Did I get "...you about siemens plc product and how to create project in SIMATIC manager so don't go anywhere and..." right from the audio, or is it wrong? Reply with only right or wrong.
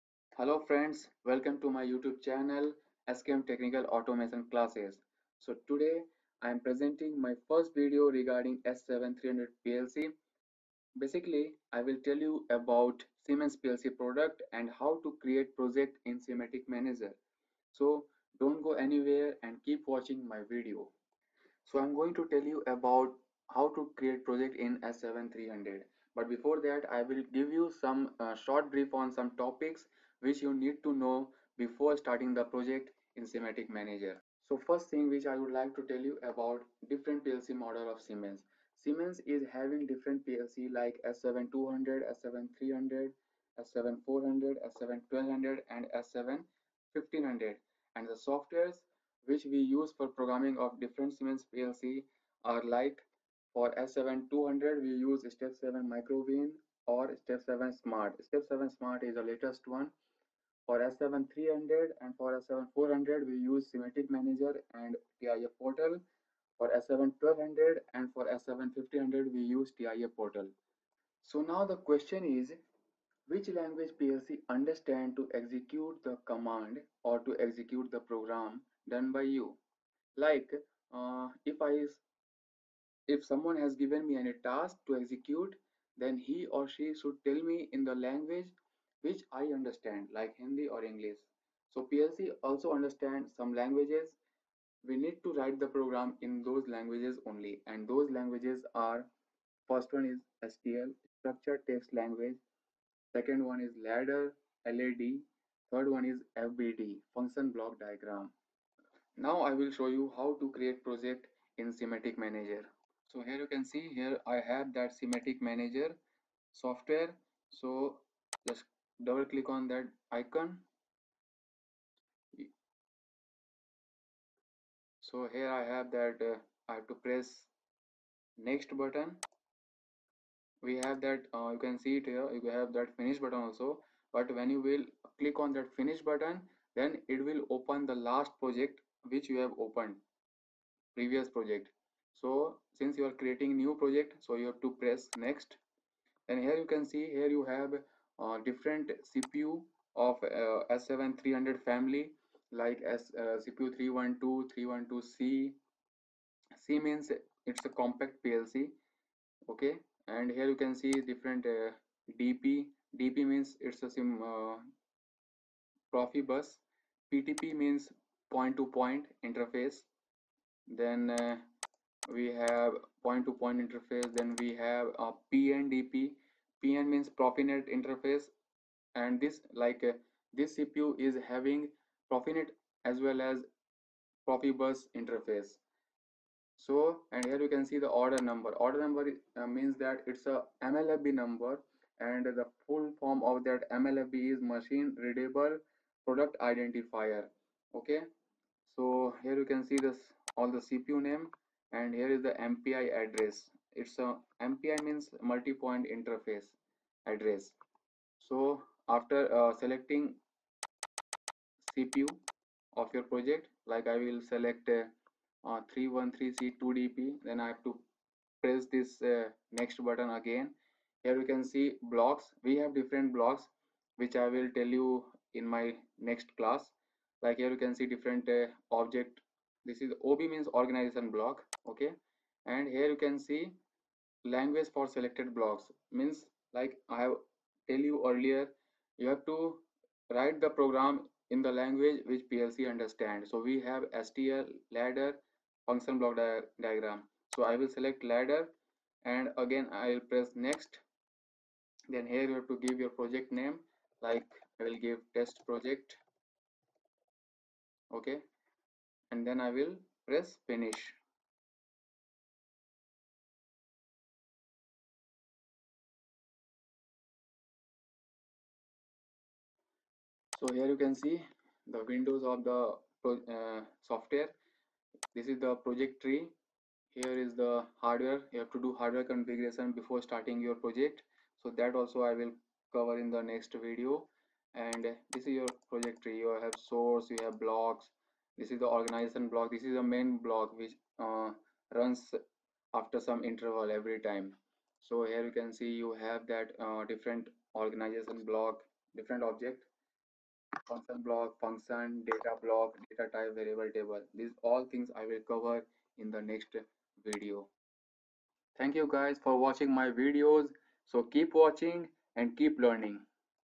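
right.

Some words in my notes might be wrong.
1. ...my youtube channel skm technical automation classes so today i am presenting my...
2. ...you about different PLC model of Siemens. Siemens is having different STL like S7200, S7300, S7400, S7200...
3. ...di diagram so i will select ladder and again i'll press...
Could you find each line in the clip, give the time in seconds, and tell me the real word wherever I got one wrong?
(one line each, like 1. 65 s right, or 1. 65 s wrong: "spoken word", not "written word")
1. 1 s right
2. 36 s wrong: "PLC", not "STL"
3. 246 s right.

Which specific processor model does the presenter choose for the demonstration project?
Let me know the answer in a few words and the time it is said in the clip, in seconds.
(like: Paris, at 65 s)
313C2DP, at 215 s.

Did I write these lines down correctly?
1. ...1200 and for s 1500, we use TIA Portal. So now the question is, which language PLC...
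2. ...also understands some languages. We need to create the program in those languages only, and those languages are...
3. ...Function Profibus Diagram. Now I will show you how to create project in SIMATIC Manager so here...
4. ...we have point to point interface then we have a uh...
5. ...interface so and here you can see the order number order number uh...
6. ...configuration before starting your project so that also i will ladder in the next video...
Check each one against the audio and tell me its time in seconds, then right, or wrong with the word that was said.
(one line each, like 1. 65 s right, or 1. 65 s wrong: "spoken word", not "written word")
1. 66 s right
2. 92 s wrong: "write", not "create"
3. 107 s wrong: "Block", not "Profibus"
4. 172 s right
5. 184 s right
6. 279 s wrong: "cover", not "ladder".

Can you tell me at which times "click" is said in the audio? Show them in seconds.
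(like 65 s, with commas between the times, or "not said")
119 s, 135 s.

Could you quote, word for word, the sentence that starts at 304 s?
These all things I will cover in the next video.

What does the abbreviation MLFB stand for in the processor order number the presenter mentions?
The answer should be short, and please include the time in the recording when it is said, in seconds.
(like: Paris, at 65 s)
machine readable product identifier, at 194 s.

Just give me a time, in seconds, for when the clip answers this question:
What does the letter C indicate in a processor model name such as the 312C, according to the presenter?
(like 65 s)
157 s.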